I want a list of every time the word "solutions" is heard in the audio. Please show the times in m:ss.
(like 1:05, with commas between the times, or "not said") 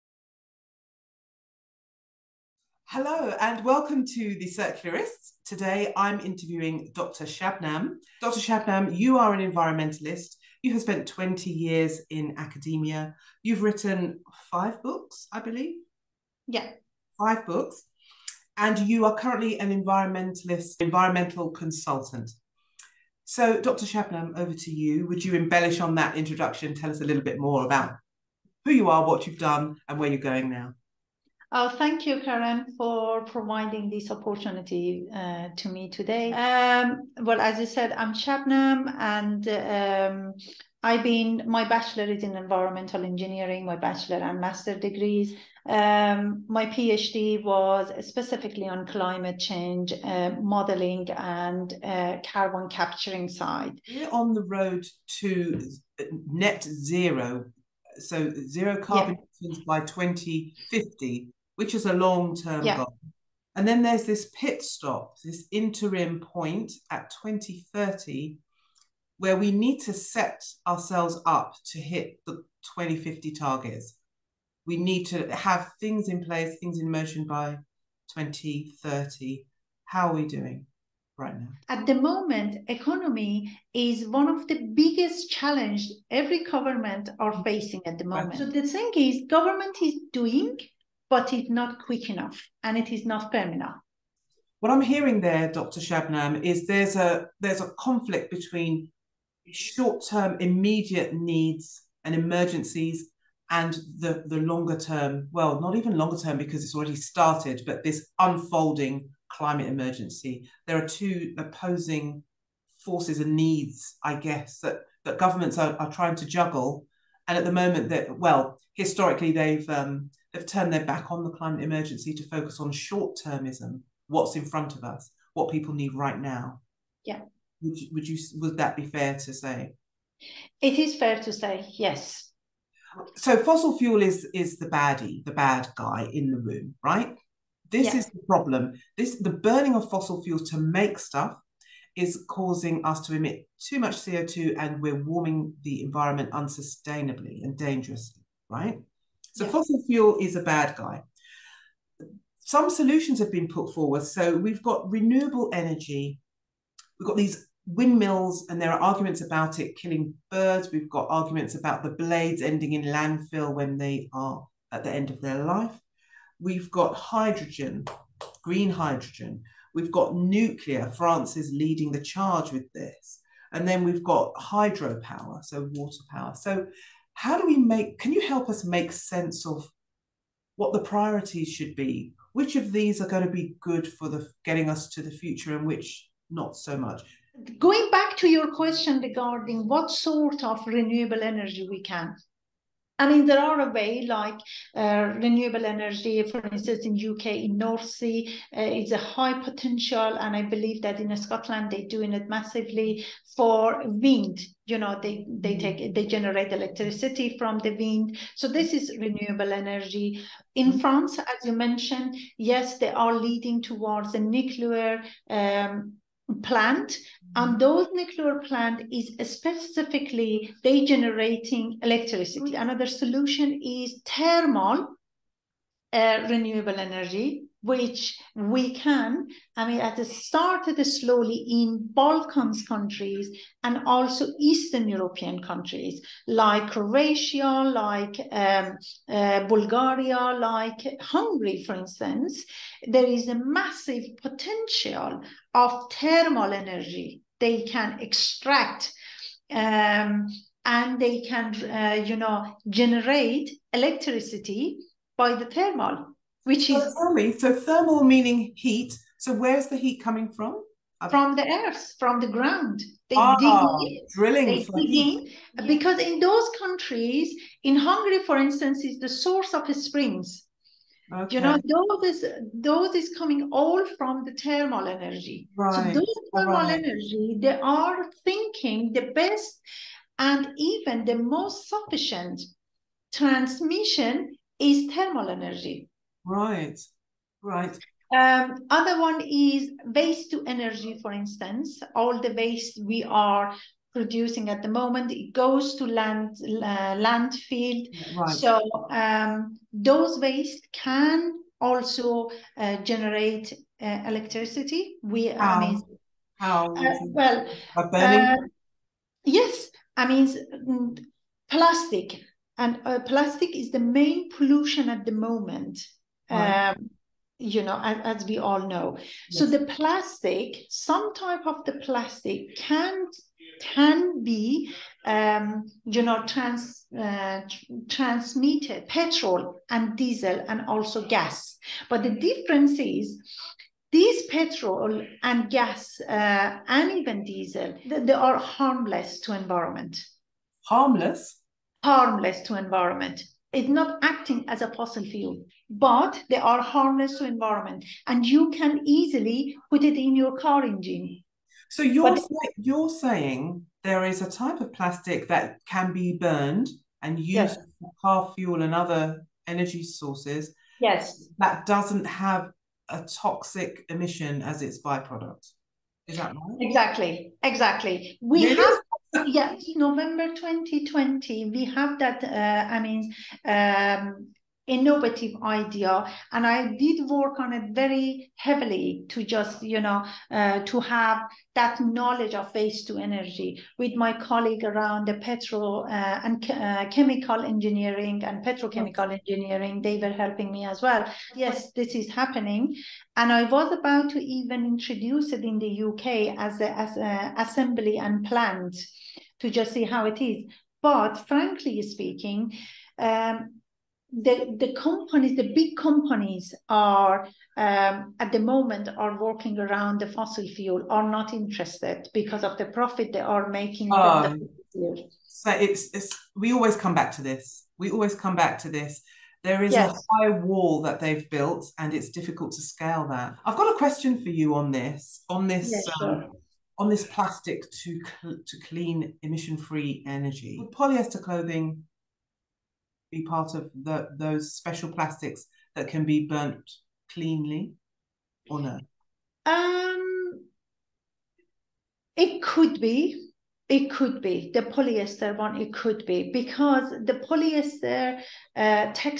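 2:32, 3:42.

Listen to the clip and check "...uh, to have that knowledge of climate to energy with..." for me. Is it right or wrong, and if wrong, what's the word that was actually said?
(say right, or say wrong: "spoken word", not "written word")
wrong: "waste", not "climate".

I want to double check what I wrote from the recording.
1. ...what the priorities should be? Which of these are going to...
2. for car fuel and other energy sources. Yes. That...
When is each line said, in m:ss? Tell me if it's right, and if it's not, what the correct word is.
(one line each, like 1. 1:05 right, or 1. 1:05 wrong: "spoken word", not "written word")
1. 3:00 right
2. 5:57 right.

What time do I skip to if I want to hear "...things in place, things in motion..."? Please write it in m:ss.
1:15.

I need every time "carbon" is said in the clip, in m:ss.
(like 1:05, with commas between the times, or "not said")
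0:52, 0:58.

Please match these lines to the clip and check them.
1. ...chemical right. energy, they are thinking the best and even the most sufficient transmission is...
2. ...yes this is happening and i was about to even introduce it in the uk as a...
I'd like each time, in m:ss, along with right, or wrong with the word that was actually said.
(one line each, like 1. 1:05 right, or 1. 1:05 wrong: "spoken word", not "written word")
1. 4:36 wrong: "thermal", not "chemical"
2. 6:31 right.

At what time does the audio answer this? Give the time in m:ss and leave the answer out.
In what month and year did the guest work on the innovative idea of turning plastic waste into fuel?
6:09.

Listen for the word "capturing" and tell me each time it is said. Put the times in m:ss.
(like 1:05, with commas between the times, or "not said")
0:52.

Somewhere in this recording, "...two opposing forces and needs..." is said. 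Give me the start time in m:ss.
1:50.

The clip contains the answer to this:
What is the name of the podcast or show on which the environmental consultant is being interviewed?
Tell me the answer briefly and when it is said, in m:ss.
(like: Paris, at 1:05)
The Circularists, at 0:04.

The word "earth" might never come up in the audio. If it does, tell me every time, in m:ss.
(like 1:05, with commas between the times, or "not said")
4:21.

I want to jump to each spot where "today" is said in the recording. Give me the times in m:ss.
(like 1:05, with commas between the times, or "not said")
0:05, 0:35.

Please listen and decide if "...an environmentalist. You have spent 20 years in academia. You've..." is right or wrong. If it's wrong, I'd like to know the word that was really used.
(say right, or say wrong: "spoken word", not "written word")
right.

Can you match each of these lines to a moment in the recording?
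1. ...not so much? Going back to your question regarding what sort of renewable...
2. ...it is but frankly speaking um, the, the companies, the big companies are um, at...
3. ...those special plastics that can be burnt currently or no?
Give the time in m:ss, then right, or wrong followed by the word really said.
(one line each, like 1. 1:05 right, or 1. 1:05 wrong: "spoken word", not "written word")
1. 3:06 right
2. 6:40 right
3. 7:14 wrong: "cleanly", not "currently".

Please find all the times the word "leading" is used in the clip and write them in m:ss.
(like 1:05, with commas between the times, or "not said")
2:51, 3:33.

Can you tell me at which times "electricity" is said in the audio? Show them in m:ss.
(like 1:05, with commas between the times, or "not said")
3:26, 3:41, 4:13, 5:04.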